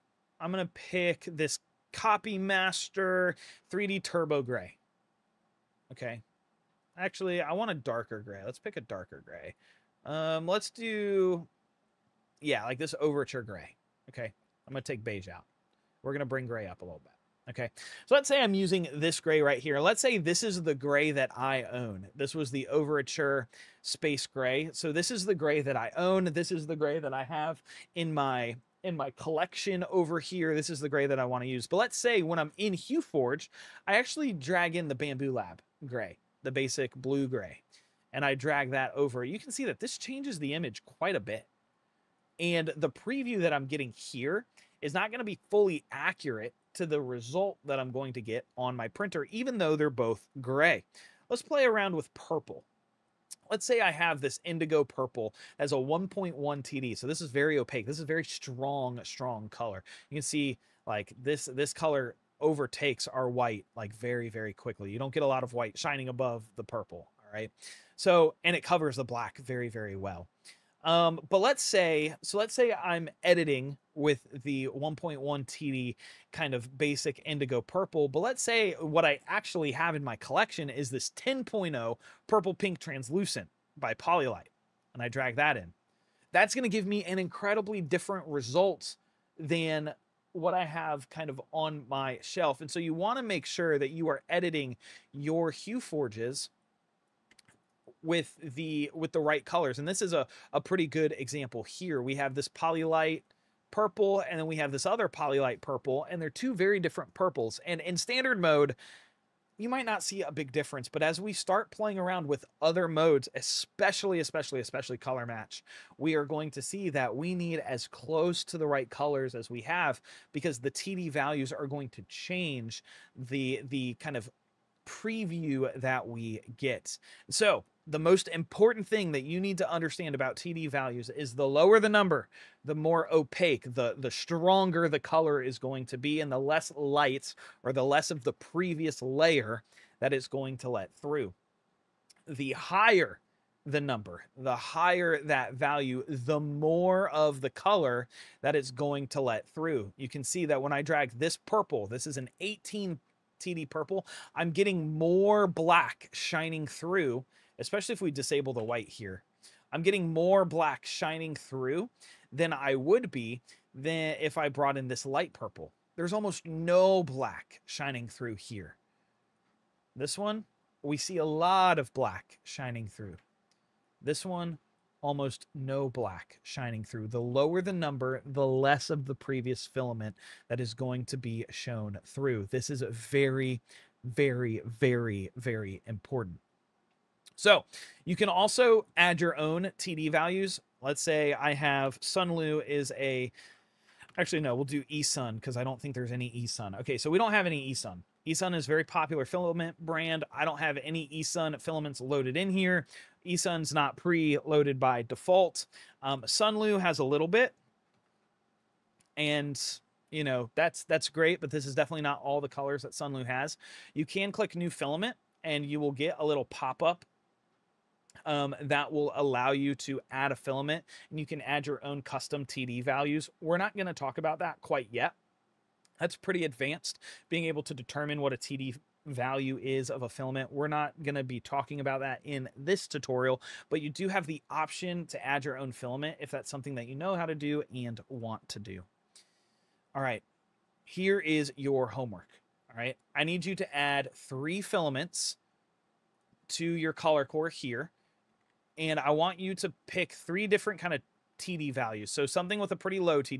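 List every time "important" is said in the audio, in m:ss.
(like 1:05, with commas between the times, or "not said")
2:08, 3:05.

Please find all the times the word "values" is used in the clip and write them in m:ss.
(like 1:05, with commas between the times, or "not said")
2:01, 2:10, 2:25, 3:10, 3:42, 3:49, 4:11.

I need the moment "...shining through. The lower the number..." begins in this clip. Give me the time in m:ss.
2:56.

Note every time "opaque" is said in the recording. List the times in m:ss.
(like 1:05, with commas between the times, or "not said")
0:57, 2:13.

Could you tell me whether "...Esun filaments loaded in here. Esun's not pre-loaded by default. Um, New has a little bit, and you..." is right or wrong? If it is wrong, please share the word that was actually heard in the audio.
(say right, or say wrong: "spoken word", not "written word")
wrong: "Sunlu", not "New".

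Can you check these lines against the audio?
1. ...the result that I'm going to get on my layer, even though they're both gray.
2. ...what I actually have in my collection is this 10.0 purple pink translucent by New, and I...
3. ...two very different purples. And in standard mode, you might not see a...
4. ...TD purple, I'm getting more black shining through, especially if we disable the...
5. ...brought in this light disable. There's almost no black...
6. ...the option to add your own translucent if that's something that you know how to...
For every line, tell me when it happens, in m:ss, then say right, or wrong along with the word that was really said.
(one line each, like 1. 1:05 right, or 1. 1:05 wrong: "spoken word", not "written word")
1. 0:46 wrong: "printer", not "layer"
2. 1:18 wrong: "Polylite", not "New"
3. 1:46 right
4. 2:33 right
5. 2:44 wrong: "purple", not "disable"
6. 3:54 wrong: "filament", not "translucent".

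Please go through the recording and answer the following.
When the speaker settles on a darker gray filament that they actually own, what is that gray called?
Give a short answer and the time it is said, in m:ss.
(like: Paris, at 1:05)
Overture Space Gray, at 0:22.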